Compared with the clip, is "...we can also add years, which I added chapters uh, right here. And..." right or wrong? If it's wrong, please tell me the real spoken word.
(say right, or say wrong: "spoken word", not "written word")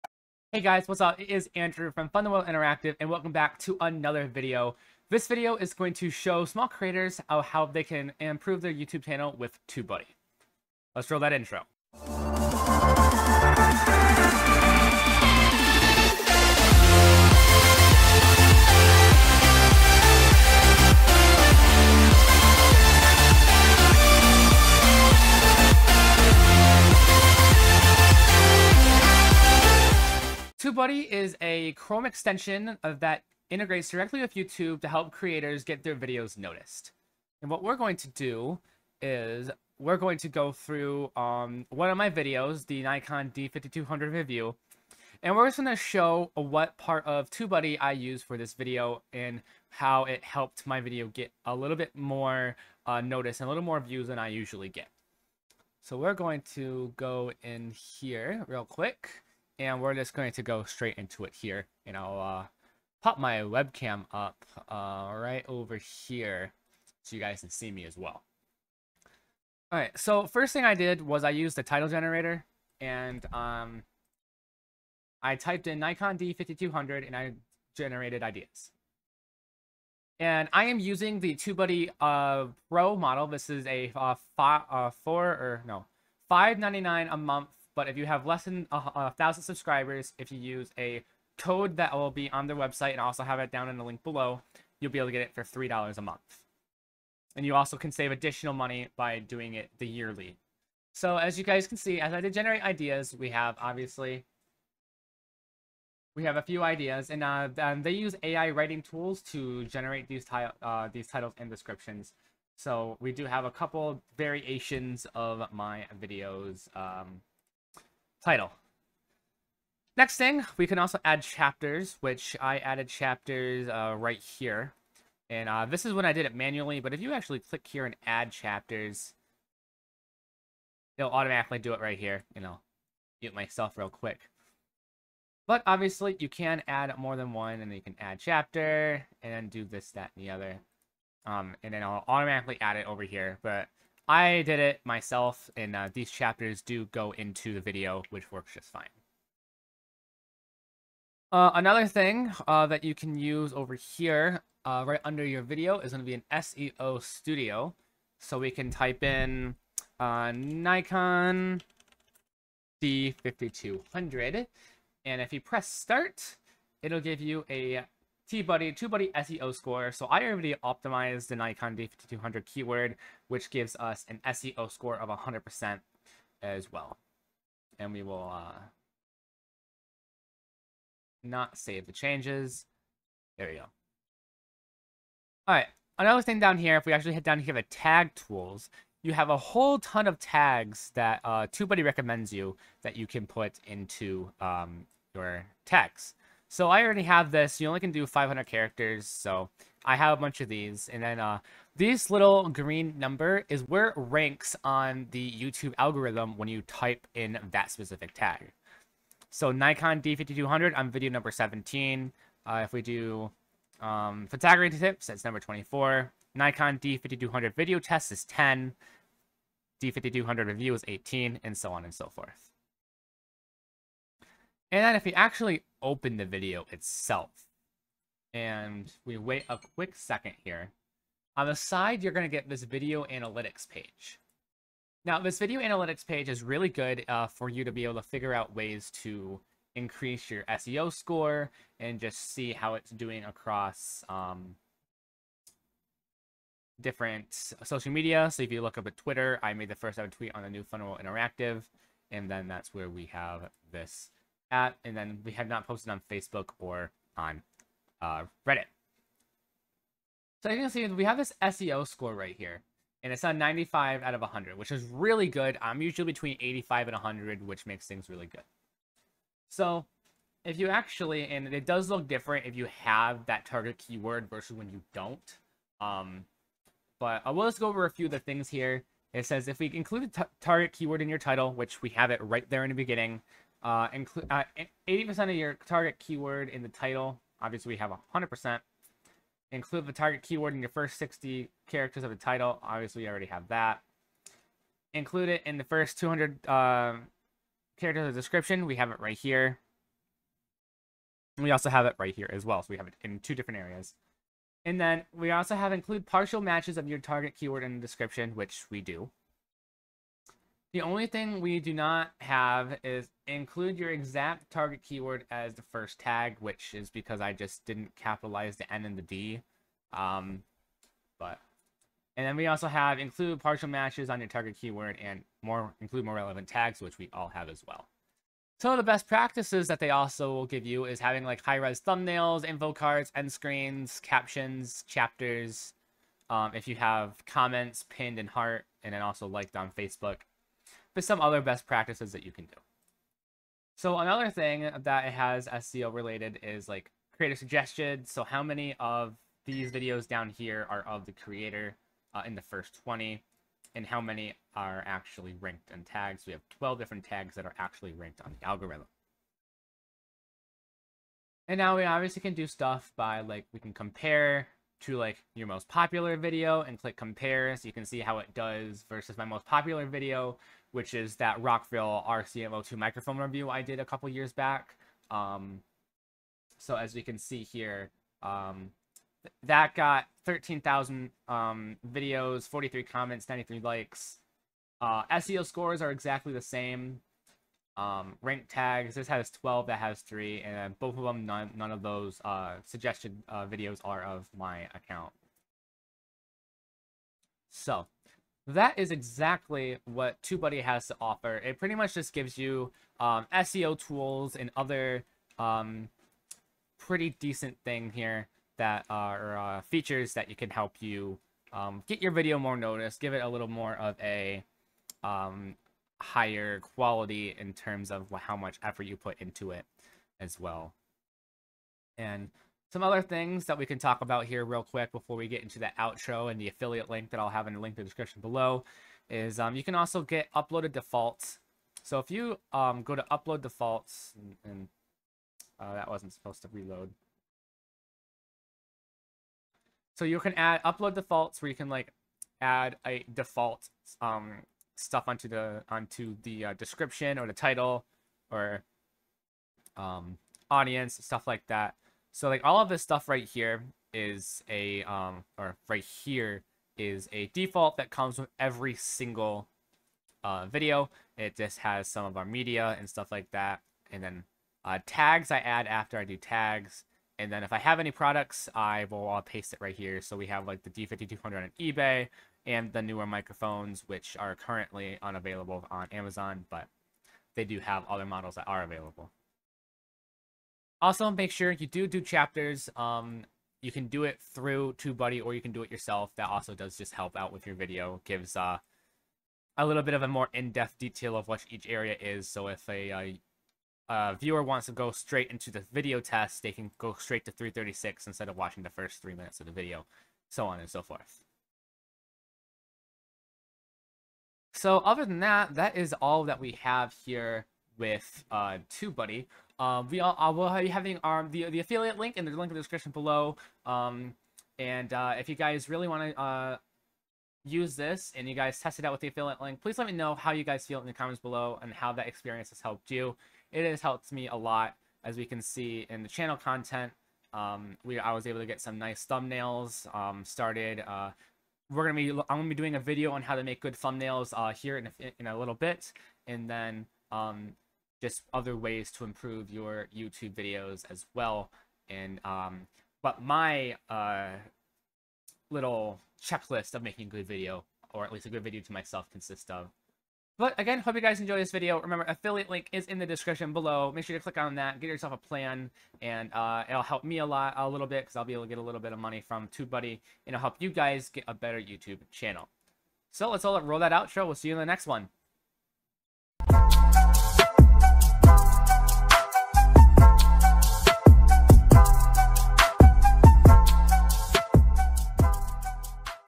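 wrong: "chapters", not "years".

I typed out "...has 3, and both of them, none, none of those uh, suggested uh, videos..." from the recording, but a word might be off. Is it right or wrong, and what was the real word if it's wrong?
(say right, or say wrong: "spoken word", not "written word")
right.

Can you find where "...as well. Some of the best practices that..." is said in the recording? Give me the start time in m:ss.
5:27.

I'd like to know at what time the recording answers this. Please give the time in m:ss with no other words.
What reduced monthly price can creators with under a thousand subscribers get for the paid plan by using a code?
1:35.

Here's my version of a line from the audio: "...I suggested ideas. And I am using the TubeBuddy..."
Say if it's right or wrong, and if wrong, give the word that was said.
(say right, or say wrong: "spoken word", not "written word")
wrong: "generated", not "suggested".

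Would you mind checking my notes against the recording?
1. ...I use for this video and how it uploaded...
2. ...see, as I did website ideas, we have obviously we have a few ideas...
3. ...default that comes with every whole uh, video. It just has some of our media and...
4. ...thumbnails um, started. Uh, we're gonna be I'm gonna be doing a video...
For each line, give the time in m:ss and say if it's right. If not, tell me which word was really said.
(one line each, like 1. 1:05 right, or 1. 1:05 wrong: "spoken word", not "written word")
1. 0:47 wrong: "helped", not "uploaded"
2. 1:41 wrong: "generate", not "website"
3. 7:37 wrong: "single", not "whole"
4. 8:49 right.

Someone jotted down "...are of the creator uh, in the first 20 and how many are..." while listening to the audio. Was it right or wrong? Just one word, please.
right.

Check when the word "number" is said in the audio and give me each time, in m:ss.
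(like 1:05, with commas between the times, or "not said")
3:22, 3:31, 3:35.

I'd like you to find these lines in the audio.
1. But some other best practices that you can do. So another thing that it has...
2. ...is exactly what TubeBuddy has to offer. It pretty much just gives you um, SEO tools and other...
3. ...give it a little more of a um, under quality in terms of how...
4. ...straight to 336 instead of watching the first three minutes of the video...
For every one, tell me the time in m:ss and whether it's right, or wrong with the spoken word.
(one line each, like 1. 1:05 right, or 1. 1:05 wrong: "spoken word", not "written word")
1. 5:40 right
2. 6:38 right
3. 6:52 wrong: "higher", not "under"
4. 8:16 right.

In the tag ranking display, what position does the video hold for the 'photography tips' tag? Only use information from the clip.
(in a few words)
24.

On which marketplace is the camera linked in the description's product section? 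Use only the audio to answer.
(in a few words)
eBay.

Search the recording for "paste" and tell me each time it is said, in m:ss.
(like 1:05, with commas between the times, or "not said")
7:49.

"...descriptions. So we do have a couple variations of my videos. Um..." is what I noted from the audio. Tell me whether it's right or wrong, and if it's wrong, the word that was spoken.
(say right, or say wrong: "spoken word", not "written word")
right.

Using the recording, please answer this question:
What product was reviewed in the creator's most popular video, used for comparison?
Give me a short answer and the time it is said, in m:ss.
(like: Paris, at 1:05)
Rockville RCM02 microphone, at 6:11.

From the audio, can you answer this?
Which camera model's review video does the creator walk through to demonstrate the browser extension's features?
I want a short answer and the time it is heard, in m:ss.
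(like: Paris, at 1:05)
Nikon D5200 review, at 0:42.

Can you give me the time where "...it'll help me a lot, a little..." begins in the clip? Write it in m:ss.
9:16.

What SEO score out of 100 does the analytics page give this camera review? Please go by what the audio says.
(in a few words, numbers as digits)
95.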